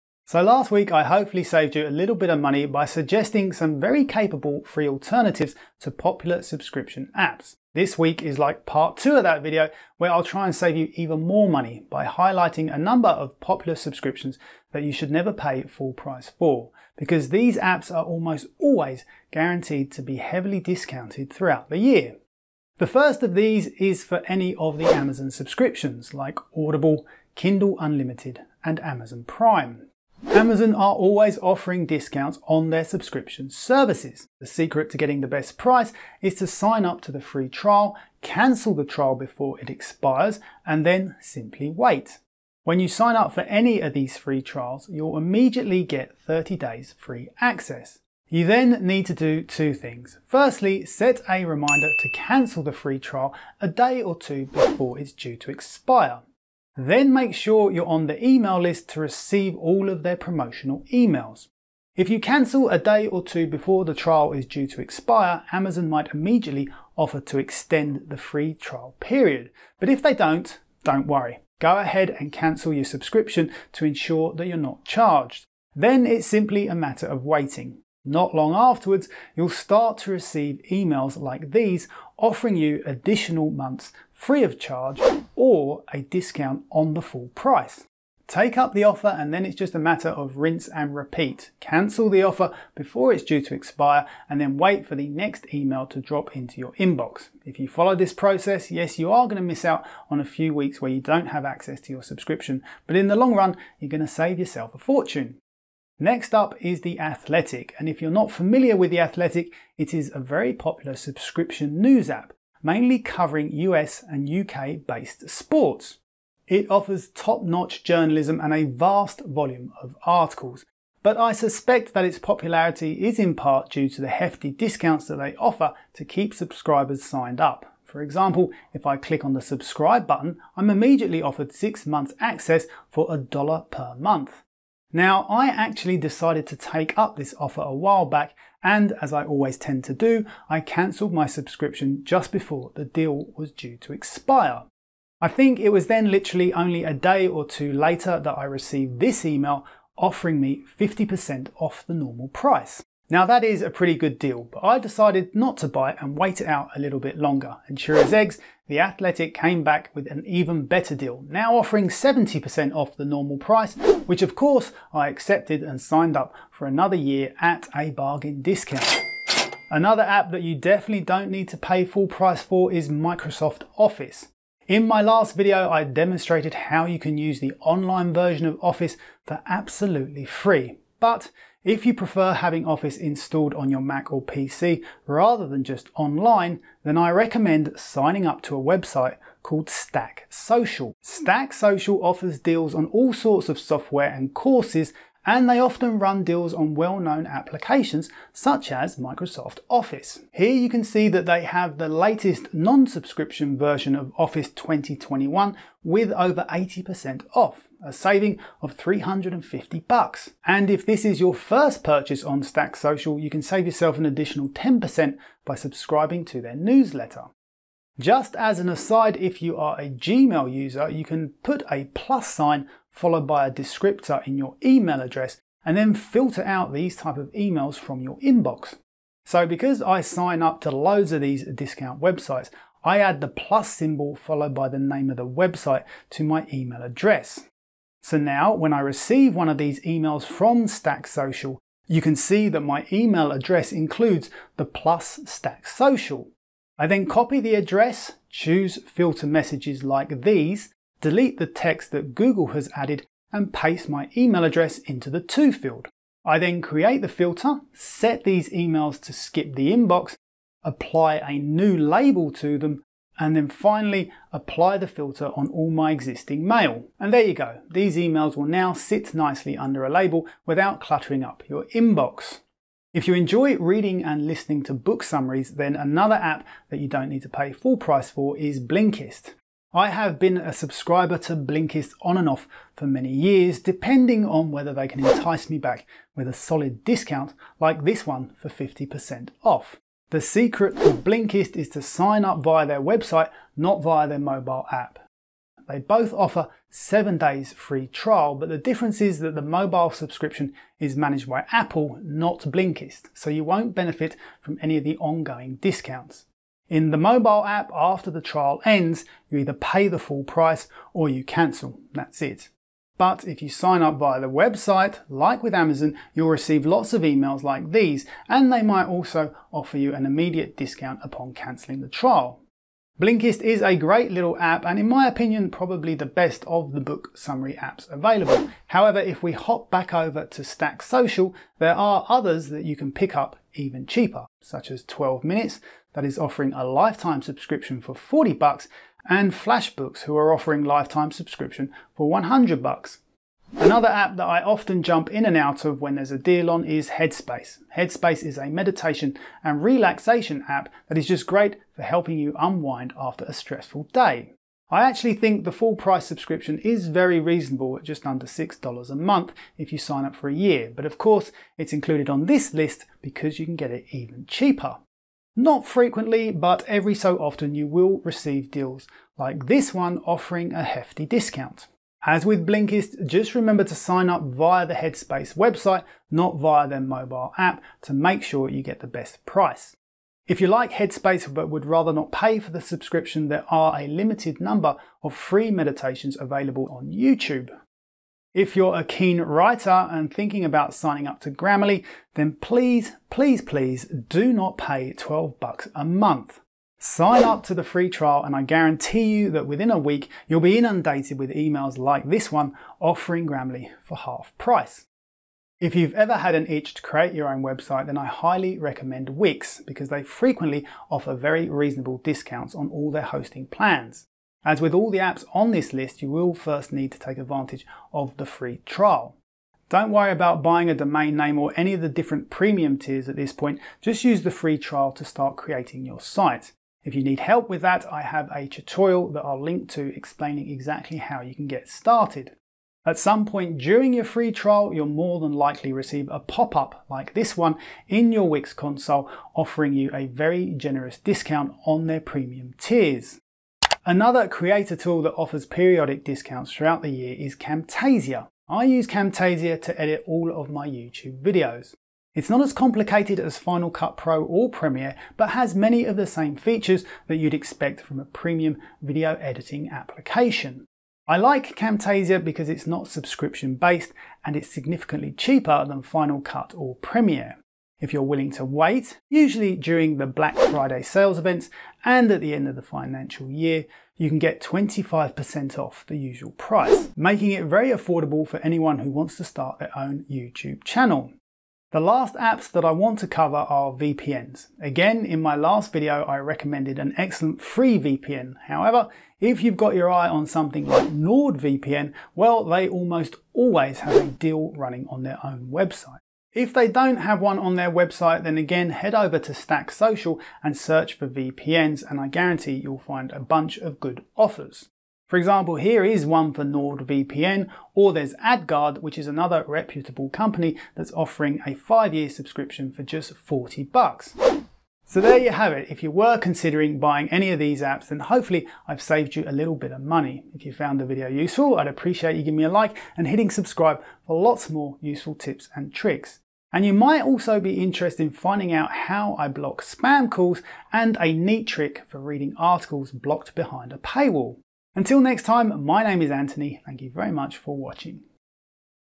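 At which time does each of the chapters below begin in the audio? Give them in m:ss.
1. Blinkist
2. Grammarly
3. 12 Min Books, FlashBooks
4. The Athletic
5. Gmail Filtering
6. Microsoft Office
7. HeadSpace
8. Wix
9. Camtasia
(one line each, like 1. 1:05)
1. 4:32
2. 6:28
3. 5:22
4. 1:45
5. 3:37
6. 2:49
7. 5:43
8. 6:45
9. 7:23.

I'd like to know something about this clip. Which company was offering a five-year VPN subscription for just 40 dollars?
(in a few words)
AdGuard.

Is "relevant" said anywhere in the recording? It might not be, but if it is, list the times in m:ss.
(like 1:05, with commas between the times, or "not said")
not said.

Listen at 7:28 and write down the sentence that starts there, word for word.
I use Camtasia to edit all of my YouTube videos.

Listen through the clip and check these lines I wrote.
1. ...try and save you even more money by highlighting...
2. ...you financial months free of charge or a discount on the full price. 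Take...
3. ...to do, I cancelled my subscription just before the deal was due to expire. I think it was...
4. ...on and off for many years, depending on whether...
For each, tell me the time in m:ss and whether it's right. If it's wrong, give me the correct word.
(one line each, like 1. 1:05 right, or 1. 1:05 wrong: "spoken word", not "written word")
1. 0:10 right
2. 1:22 wrong: "additional", not "financial"
3. 2:19 right
4. 4:42 right.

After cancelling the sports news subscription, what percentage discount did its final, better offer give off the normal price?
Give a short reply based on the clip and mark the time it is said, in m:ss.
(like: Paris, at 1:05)
70%, at 2:41.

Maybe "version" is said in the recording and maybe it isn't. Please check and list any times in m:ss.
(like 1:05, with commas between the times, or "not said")
2:58, 3:23.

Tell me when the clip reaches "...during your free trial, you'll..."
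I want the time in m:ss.
7:13.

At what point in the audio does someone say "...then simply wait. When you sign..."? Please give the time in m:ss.
0:40.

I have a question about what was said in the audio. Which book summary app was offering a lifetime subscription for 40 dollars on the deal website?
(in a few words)
12 Minutes.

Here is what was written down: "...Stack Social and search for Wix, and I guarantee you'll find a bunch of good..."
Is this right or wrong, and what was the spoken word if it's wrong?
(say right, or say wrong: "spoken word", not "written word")
wrong: "VPNs", not "Wix".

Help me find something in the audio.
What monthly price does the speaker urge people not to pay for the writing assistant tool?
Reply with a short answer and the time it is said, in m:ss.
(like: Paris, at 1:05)
$12, at 6:34.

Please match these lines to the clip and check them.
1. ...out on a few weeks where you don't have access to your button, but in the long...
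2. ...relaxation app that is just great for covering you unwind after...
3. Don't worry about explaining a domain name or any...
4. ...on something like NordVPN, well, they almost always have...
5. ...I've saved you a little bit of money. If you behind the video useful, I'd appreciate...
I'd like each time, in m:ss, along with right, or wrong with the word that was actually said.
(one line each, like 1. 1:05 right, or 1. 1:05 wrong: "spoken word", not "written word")
1. 1:39 wrong: "subscription", not "button"
2. 5:49 wrong: "helping", not "covering"
3. 6:59 wrong: "buying", not "explaining"
4. 8:10 right
5. 8:38 wrong: "found", not "behind".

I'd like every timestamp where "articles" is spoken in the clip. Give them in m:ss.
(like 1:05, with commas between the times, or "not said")
2:00, 8:52.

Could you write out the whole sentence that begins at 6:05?
Not frequently, but every so often you will receive deals like this one offering a hefty discount.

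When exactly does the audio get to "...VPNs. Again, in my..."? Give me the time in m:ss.
8:03.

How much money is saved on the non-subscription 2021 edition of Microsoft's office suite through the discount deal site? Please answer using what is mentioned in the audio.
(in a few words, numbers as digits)
$350.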